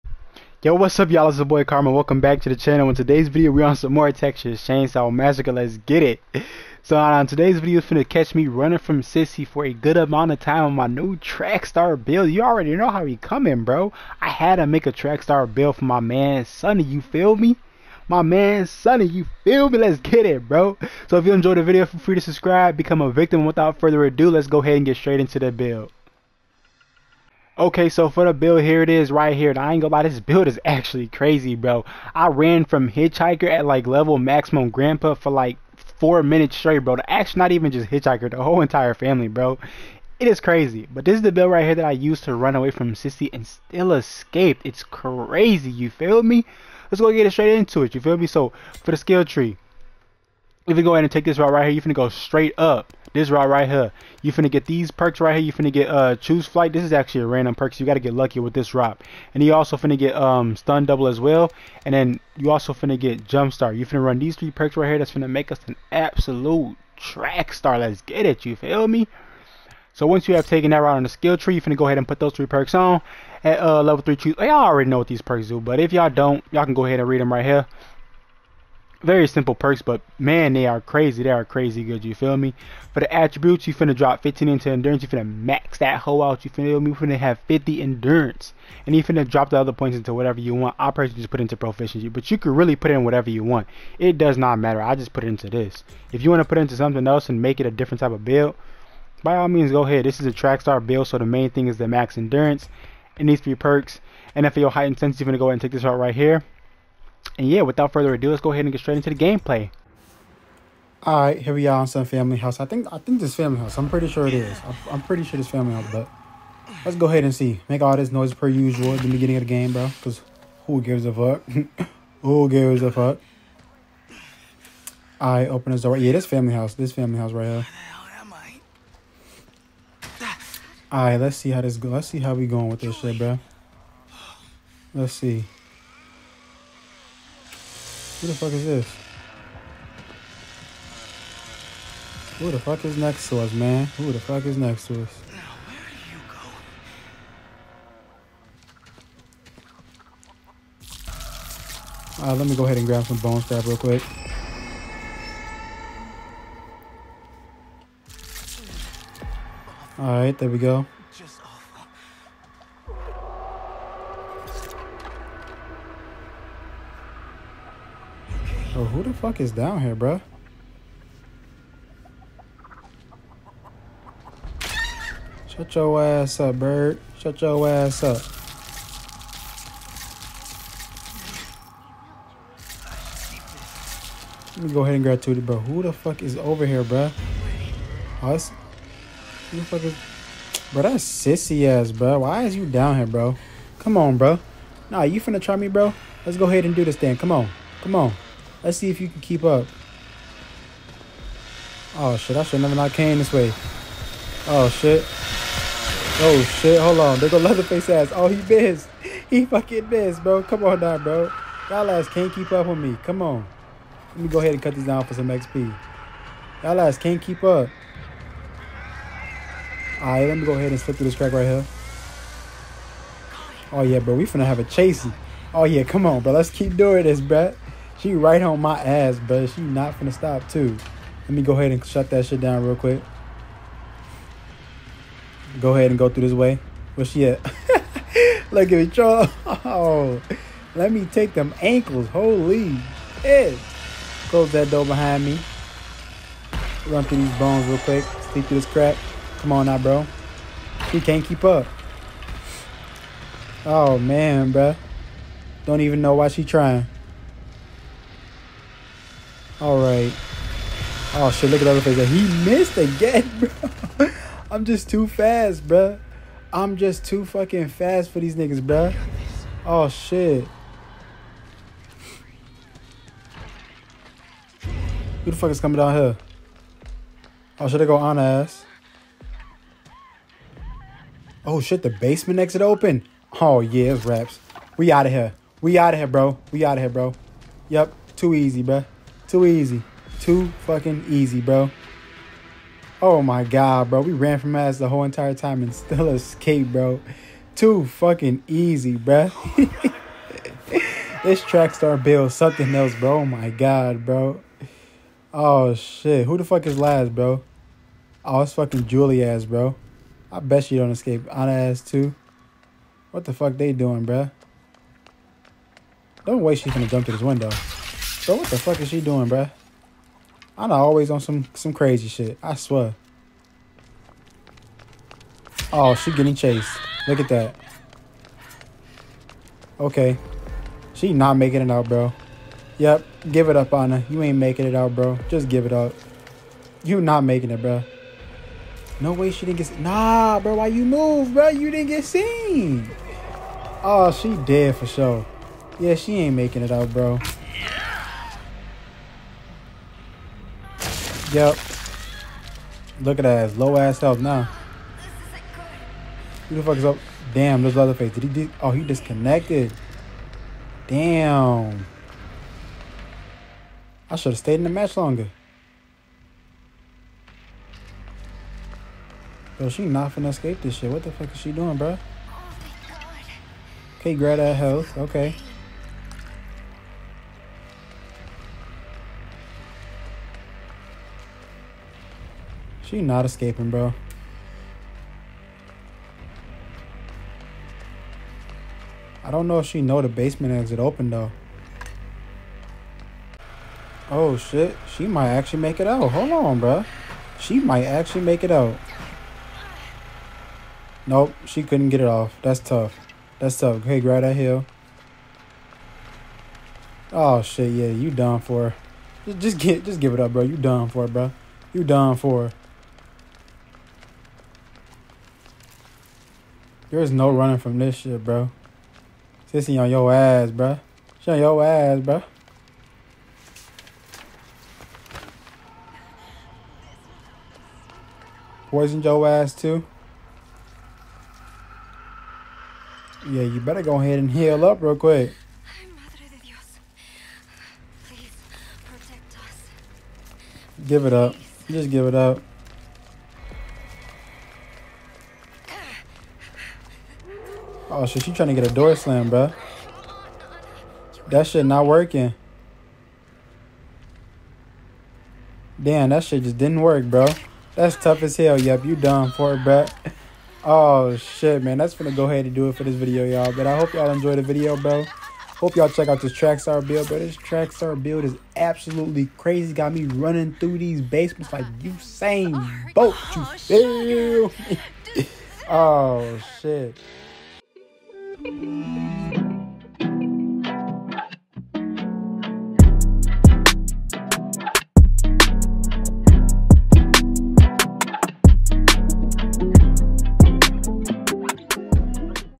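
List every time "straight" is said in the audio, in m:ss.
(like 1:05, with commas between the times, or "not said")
0:24, 0:36, 0:47, 0:52, 1:48.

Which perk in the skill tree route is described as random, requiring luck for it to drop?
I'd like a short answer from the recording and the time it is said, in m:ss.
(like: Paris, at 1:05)
Choose Flight, at 0:56.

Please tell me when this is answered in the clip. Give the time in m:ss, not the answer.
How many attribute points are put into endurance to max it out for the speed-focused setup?
1:24.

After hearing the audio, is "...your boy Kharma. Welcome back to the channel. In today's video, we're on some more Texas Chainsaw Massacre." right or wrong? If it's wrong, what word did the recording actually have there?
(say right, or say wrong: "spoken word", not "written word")
right.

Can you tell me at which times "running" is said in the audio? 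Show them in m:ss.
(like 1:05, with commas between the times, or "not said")
0:08, 6:57, 7:50.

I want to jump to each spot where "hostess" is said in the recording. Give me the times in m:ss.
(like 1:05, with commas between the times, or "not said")
not said.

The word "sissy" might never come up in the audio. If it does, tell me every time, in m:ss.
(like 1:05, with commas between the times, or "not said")
0:09, 0:42, 3:11, 6:59.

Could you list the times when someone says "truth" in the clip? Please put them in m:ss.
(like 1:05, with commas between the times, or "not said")
not said.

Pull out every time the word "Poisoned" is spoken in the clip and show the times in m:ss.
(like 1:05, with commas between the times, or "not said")
7:08.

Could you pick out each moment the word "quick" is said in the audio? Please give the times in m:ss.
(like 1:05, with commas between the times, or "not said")
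2:33, 3:52, 4:07, 7:14.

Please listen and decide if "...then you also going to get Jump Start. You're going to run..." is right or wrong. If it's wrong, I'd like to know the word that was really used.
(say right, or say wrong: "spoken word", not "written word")
right.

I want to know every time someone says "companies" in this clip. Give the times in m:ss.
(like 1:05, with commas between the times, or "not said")
not said.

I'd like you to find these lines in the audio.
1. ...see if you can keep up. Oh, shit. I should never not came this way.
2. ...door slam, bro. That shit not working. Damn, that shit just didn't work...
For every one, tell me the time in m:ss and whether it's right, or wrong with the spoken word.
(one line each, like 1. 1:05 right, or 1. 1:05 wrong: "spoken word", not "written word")
1. 3:18 right
2. 7:28 right.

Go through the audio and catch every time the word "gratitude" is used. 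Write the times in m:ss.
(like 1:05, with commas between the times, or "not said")
3:05.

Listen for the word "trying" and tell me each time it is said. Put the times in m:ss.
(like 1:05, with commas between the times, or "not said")
4:16, 7:28.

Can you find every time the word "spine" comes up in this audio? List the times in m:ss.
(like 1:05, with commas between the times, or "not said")
not said.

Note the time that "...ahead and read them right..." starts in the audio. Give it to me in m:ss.
1:16.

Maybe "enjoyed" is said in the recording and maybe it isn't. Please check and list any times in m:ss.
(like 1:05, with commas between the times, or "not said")
0:21, 7:44.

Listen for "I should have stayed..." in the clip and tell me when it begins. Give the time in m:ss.
6:04.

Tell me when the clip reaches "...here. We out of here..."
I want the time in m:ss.
4:45.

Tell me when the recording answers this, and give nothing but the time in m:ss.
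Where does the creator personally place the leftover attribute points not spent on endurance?
1:31.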